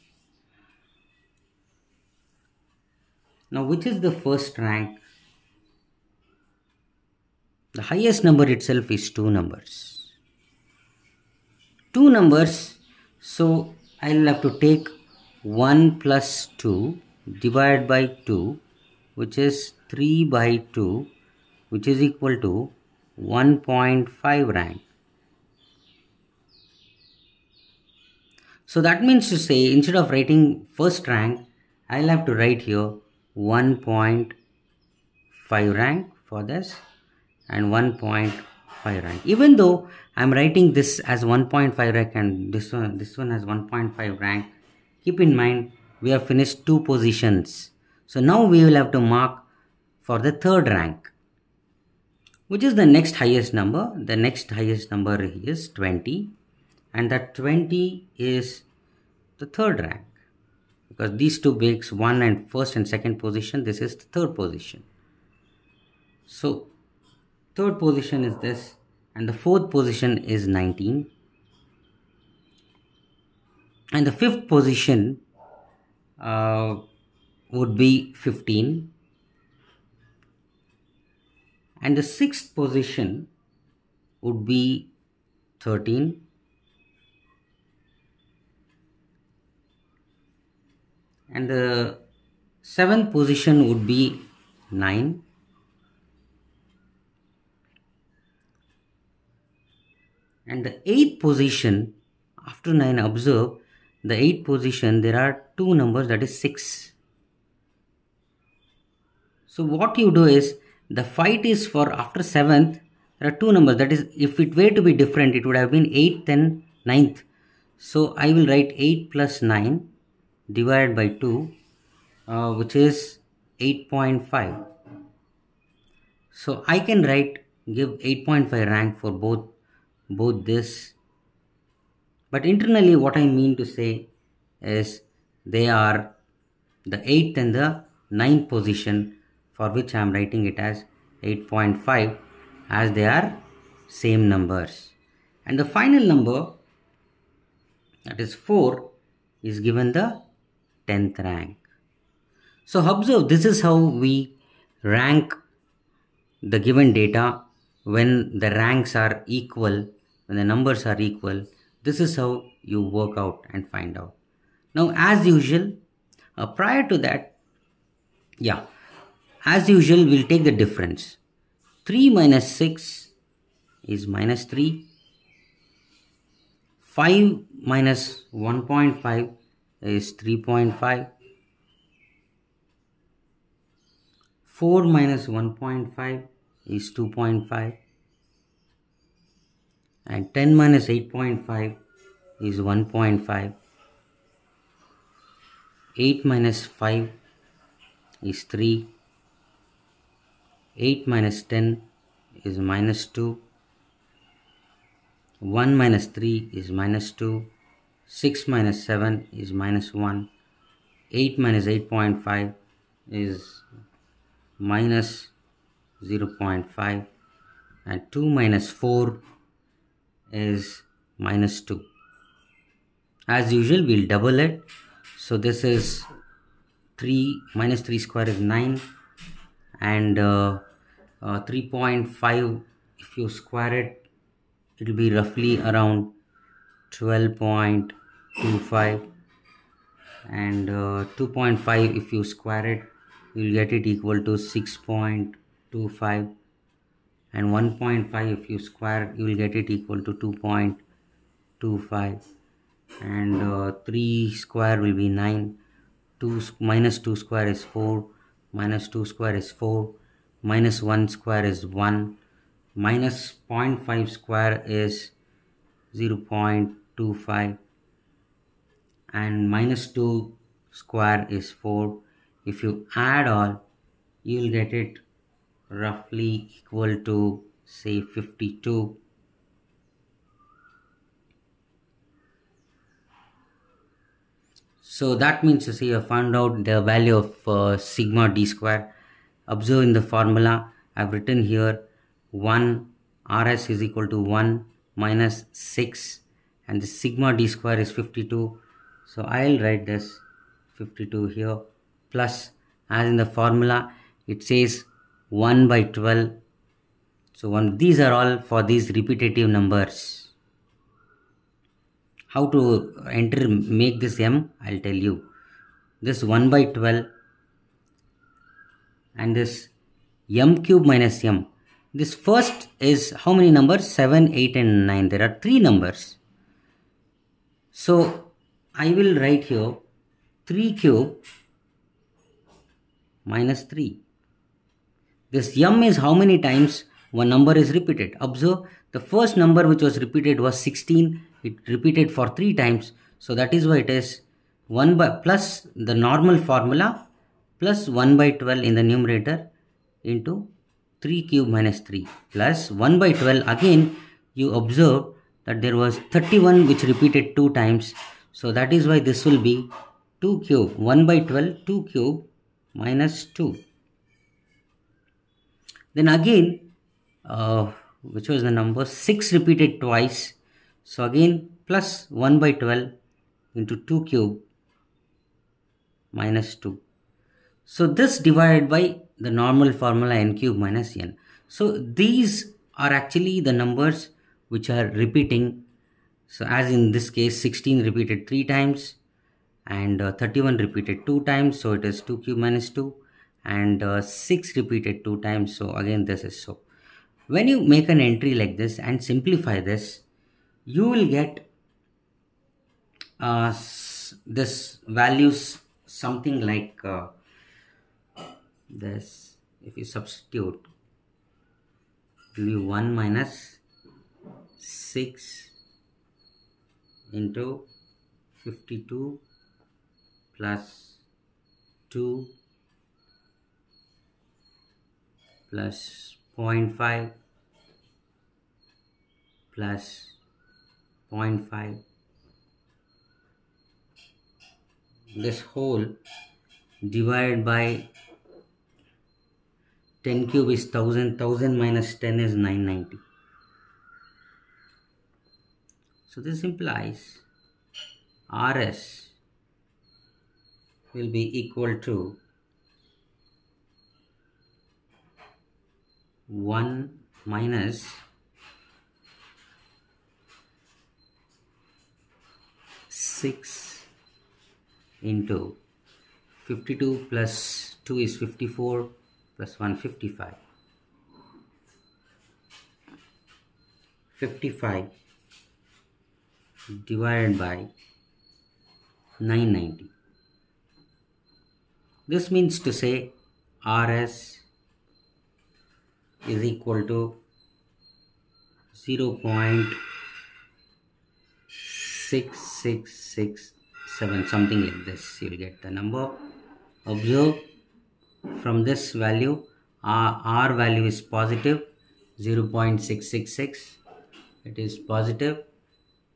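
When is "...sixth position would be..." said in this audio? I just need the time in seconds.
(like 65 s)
82 s.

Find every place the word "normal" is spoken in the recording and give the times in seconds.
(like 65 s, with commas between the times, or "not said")
345 s, 379 s.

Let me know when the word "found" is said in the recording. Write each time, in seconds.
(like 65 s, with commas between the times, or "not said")
286 s.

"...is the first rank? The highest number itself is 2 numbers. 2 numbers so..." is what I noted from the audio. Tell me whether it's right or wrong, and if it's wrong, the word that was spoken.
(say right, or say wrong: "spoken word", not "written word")
right.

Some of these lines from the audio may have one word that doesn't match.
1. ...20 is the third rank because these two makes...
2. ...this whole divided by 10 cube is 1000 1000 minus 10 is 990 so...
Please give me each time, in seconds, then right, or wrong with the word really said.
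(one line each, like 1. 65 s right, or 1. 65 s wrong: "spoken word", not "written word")
1. 57 s right
2. 435 s right.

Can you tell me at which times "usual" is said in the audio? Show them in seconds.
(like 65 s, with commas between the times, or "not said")
165 s, 169 s, 223 s.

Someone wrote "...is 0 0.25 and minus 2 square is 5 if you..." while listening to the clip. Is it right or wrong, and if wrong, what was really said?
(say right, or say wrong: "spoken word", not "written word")
wrong: "4", not "5".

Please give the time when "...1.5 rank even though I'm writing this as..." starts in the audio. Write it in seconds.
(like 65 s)
37 s.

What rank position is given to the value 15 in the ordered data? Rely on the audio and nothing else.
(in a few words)
fifth.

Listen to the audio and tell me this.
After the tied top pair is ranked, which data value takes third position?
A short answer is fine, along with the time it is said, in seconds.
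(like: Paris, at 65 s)
20, at 53 s.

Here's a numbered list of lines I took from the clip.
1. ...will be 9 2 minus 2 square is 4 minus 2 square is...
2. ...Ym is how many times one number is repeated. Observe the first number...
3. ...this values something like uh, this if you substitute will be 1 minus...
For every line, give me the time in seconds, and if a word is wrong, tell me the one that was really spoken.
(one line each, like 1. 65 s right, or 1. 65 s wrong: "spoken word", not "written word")
1. 254 s right
2. 335 s right
3. 404 s right.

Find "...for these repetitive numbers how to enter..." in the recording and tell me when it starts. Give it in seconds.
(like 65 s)
308 s.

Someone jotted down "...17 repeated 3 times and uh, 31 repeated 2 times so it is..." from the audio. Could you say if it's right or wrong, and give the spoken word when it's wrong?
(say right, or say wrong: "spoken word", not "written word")
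wrong: "16", not "17".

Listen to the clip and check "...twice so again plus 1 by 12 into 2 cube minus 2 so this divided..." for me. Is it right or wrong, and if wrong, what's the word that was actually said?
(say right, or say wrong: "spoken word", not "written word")
right.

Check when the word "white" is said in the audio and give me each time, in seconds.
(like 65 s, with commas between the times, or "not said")
not said.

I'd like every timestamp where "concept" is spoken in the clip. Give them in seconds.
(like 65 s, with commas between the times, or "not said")
not said.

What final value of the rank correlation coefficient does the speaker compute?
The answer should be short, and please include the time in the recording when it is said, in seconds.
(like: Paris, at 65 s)
0.6667, at 488 s.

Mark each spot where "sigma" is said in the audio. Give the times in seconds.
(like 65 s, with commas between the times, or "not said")
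287 s, 296 s.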